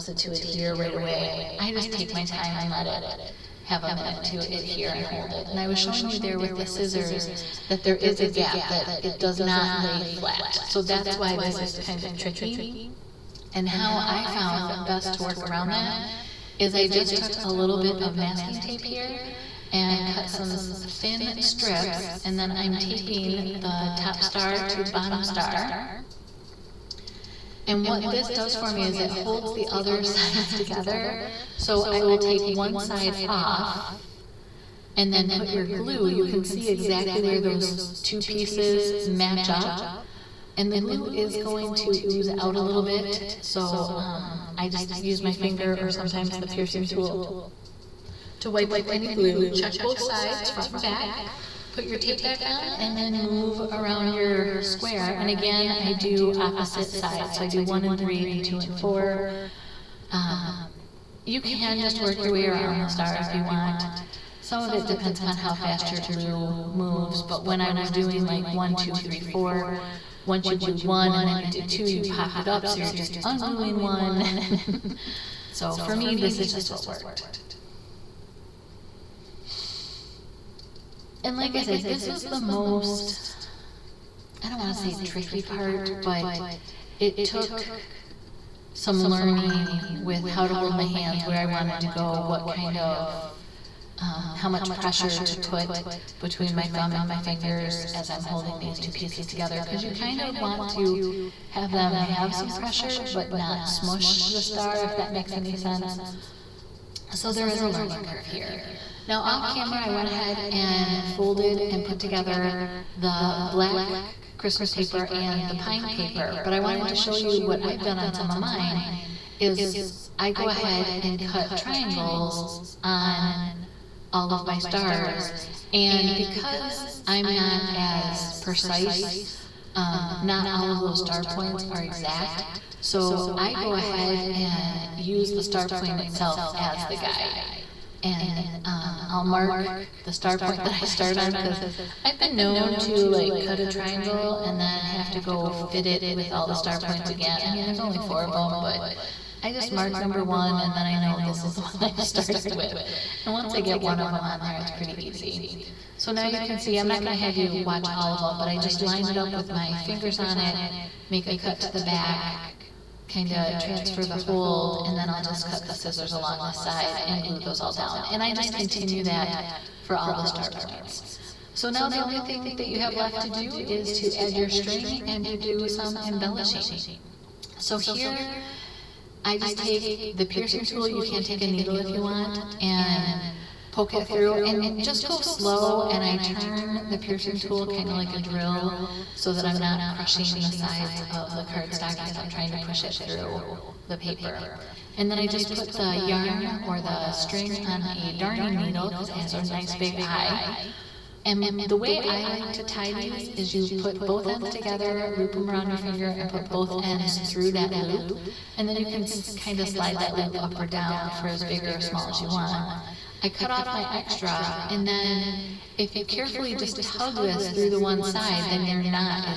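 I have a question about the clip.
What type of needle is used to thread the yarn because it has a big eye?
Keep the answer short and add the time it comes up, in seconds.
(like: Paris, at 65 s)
Darning needle, at 198 s.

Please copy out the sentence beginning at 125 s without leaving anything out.
And because I'm not as precise, um, not all of those star points are exact.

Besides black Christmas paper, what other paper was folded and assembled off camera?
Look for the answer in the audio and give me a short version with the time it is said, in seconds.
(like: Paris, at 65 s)
Pine paper, at 115 s.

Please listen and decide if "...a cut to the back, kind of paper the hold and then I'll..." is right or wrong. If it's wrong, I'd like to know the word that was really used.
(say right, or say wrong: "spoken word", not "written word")
wrong: "transfer", not "paper".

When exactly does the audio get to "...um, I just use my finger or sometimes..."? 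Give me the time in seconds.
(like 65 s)
43 s.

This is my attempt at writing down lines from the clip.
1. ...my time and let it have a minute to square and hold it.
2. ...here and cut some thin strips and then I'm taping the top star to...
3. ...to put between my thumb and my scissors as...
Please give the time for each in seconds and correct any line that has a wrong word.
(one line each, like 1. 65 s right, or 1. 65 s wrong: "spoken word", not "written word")
1. 2 s wrong: "adhere", not "square"
2. 18 s right
3. 95 s wrong: "fingers", not "scissors".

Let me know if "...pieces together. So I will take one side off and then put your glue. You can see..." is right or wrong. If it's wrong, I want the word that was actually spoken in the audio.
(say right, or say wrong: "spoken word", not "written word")
wrong: "sides", not "pieces".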